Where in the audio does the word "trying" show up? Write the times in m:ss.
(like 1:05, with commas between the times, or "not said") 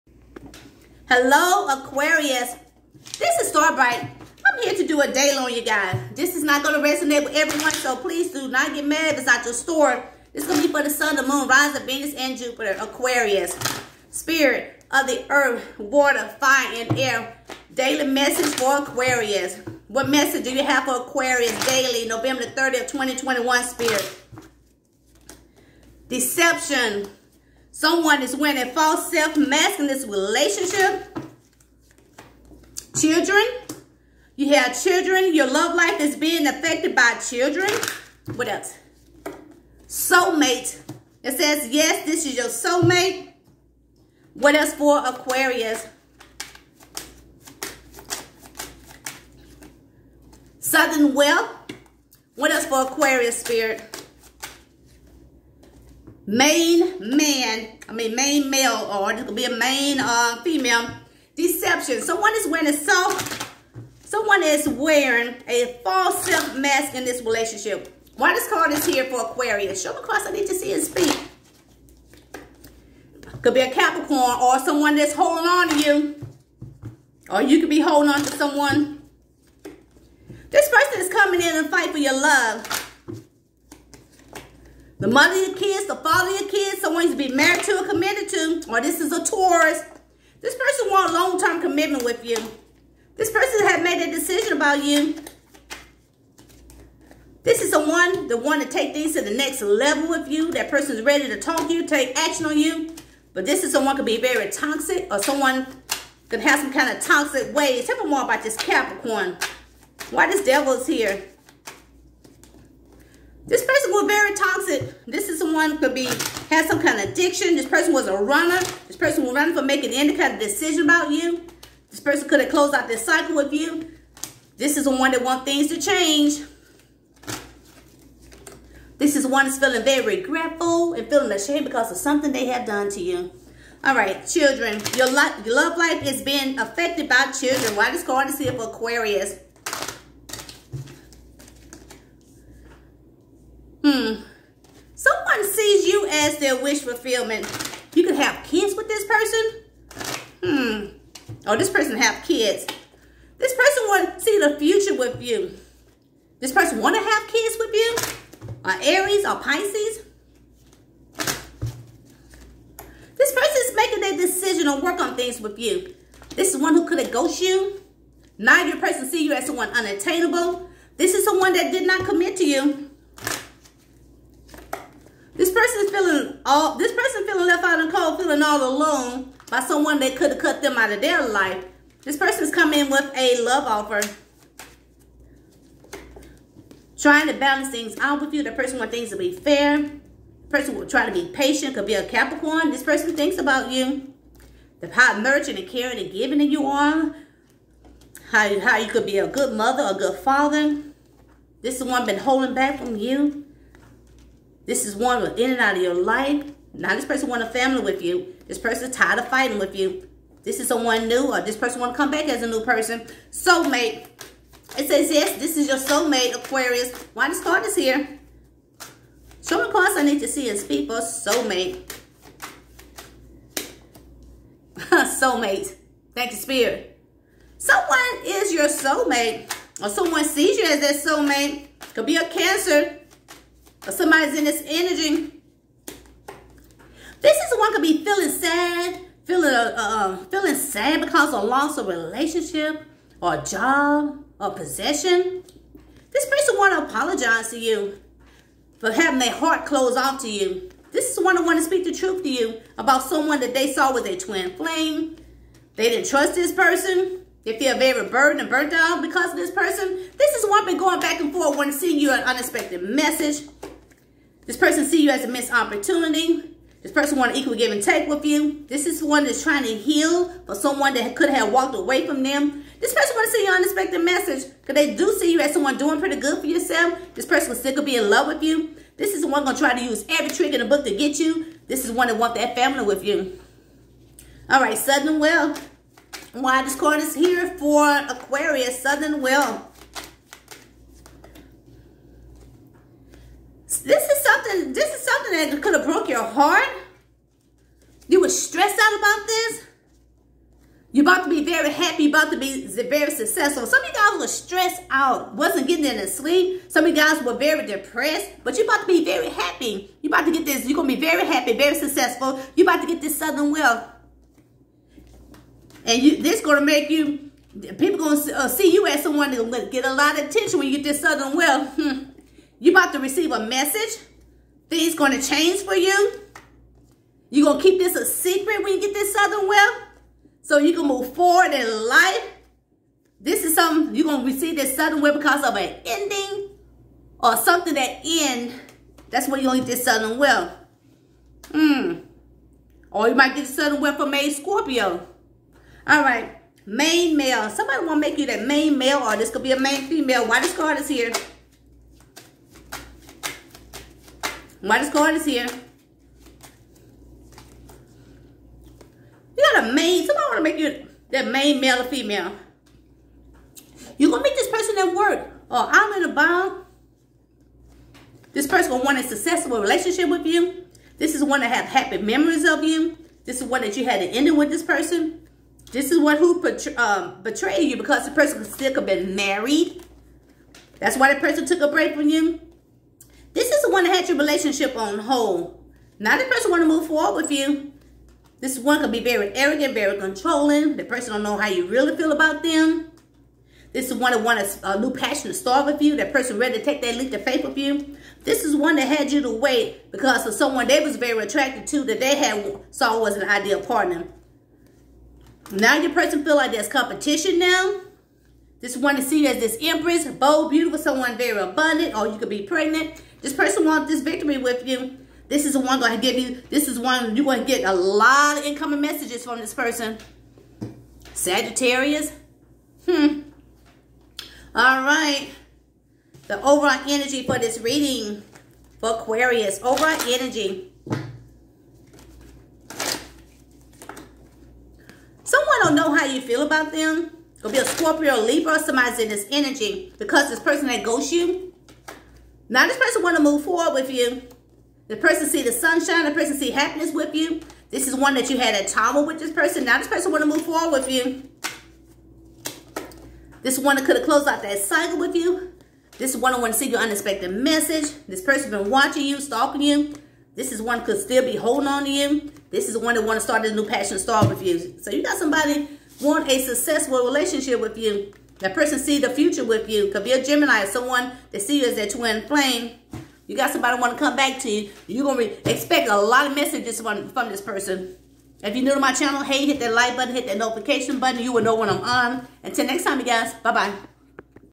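3:06, 4:29.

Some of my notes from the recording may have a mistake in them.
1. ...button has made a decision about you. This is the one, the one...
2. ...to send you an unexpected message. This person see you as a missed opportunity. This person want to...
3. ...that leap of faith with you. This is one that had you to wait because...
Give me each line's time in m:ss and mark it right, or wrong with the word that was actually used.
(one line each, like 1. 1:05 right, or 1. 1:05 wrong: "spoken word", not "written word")
1. 1:33 wrong: "person", not "button"
2. 4:21 right
3. 6:36 right.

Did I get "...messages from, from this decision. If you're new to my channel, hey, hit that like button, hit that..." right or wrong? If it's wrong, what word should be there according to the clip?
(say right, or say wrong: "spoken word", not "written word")
wrong: "person", not "decision".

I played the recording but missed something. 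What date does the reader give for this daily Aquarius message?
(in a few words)
November 30th, 2021.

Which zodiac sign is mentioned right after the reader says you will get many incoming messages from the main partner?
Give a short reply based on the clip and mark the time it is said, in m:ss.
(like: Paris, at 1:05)
Sagittarius, at 7:01.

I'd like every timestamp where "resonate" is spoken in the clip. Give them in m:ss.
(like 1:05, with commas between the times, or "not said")
0:06.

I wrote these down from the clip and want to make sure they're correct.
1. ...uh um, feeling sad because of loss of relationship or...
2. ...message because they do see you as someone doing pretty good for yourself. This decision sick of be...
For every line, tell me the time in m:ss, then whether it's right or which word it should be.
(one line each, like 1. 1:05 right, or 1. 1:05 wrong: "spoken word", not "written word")
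1. 3:59 right
2. 4:34 wrong: "person", not "decision".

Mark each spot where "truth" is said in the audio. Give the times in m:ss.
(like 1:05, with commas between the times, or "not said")
4:11.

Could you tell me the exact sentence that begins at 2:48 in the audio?
Neither person see you as someone unattainable.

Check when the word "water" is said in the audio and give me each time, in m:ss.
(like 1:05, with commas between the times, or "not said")
0:15.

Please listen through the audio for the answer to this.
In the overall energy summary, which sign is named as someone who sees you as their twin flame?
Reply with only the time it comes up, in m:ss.
7:50.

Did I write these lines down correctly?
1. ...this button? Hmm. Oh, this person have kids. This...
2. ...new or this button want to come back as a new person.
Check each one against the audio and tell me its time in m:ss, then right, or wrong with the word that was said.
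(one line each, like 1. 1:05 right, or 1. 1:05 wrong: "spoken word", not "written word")
1. 2:28 wrong: "person", not "button"
2. 3:31 wrong: "person", not "button".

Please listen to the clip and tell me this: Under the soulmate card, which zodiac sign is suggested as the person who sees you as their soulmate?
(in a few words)
Cancer.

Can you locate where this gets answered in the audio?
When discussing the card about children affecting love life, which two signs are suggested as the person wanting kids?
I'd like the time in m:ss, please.
2:38.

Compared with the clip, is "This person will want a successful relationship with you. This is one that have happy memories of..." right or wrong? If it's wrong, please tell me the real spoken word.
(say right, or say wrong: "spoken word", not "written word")
right.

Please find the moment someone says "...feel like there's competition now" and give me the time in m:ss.
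6:46.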